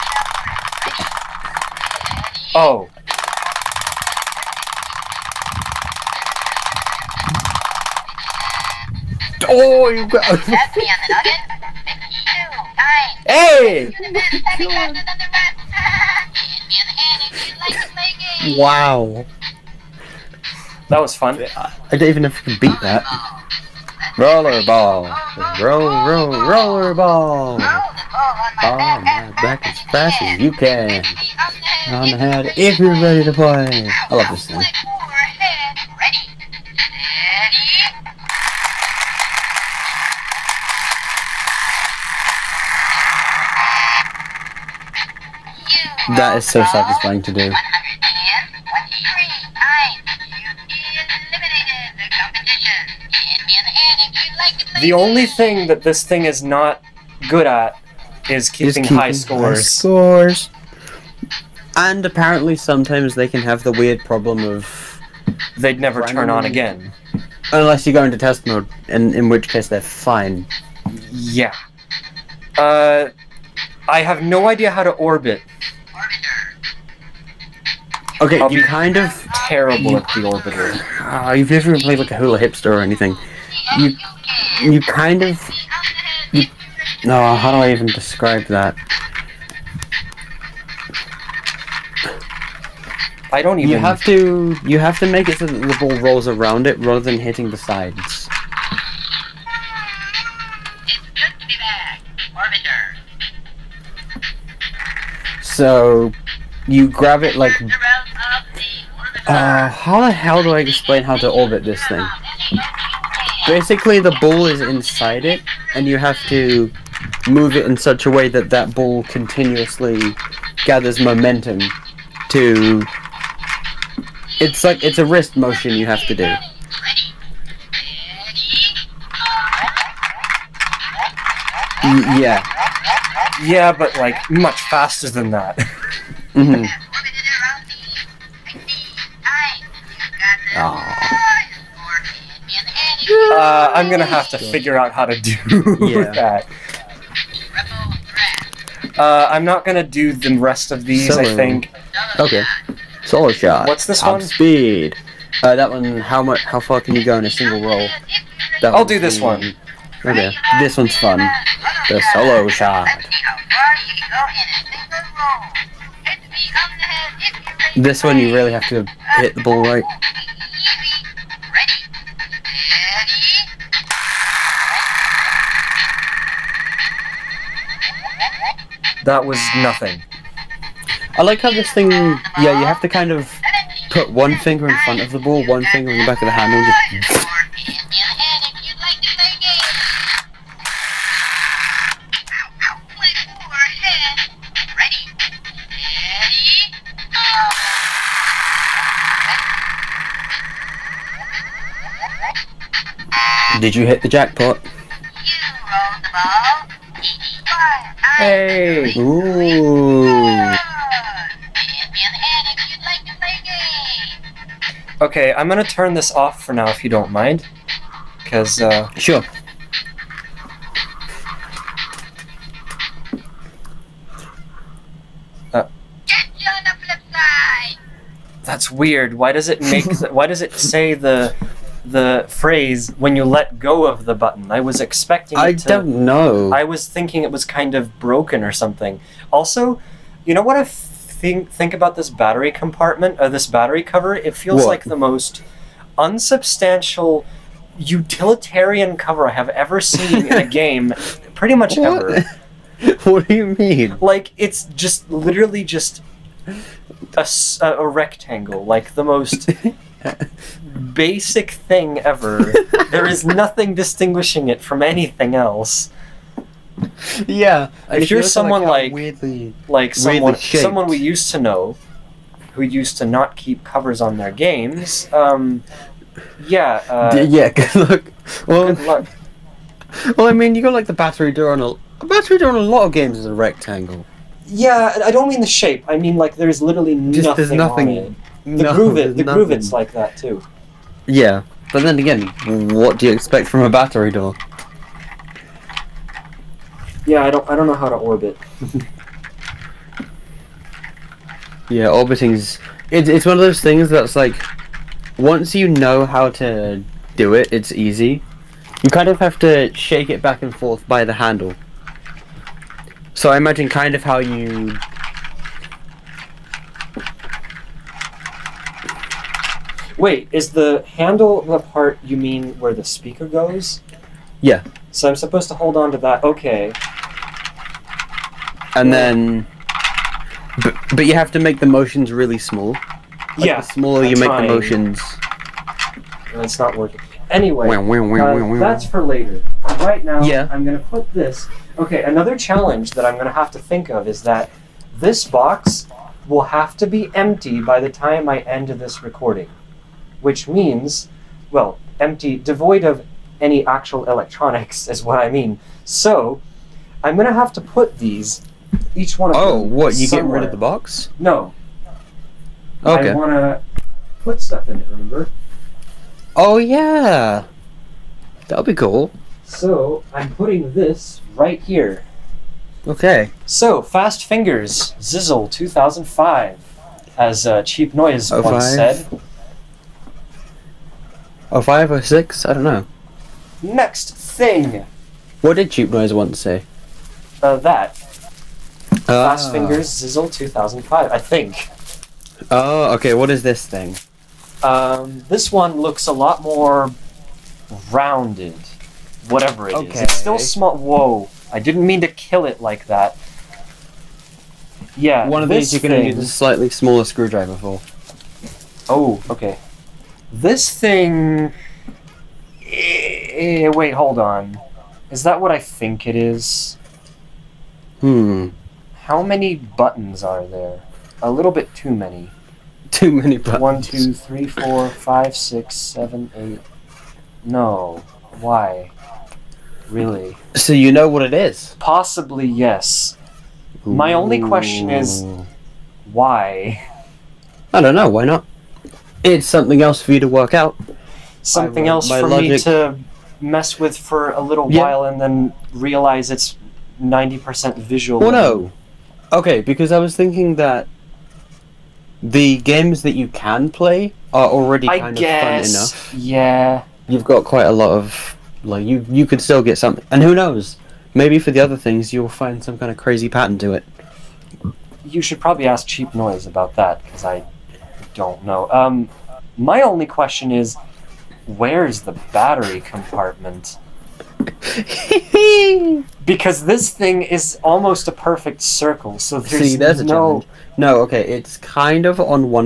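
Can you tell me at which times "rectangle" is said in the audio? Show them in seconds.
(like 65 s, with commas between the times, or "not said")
257 s, 283 s.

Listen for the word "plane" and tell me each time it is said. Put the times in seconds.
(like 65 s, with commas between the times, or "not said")
not said.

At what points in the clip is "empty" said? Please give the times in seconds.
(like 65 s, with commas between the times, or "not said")
347 s, 351 s.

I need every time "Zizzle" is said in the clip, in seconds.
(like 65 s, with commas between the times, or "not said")
374 s, 389 s.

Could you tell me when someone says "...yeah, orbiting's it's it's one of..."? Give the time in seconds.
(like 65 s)
301 s.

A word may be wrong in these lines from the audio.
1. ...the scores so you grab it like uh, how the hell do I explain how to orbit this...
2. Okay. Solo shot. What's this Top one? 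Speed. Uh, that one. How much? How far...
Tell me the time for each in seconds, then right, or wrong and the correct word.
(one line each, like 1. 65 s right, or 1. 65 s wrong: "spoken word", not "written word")
1. 97 s wrong: "sides", not "scores"
2. 152 s right.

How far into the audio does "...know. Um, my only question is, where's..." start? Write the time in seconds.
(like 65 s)
468 s.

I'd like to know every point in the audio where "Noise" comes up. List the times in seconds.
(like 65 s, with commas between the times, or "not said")
377 s, 385 s, 466 s.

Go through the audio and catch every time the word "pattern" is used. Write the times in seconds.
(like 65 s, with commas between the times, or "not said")
463 s.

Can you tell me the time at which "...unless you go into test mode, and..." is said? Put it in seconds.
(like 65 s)
67 s.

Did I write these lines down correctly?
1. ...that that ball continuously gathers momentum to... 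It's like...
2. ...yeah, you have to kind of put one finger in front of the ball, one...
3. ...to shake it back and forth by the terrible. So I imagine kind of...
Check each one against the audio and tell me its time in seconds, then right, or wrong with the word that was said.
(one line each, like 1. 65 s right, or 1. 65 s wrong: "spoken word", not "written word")
1. 118 s right
2. 181 s right
3. 309 s wrong: "handle", not "terrible".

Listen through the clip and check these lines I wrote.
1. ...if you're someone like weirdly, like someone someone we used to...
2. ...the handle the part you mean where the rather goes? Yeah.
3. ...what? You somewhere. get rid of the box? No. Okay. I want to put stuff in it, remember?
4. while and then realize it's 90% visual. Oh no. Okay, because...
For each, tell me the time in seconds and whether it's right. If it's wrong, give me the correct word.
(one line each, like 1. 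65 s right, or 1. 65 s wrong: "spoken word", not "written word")
1. 267 s right
2. 320 s wrong: "speaker", not "rather"
3. 359 s right
4. 444 s right.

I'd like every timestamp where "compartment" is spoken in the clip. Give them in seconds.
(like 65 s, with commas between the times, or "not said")
242 s, 472 s.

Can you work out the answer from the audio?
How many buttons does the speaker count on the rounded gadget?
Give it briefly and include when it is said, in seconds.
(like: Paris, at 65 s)
8, at 426 s.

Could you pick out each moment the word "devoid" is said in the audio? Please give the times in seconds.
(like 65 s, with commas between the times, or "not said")
352 s.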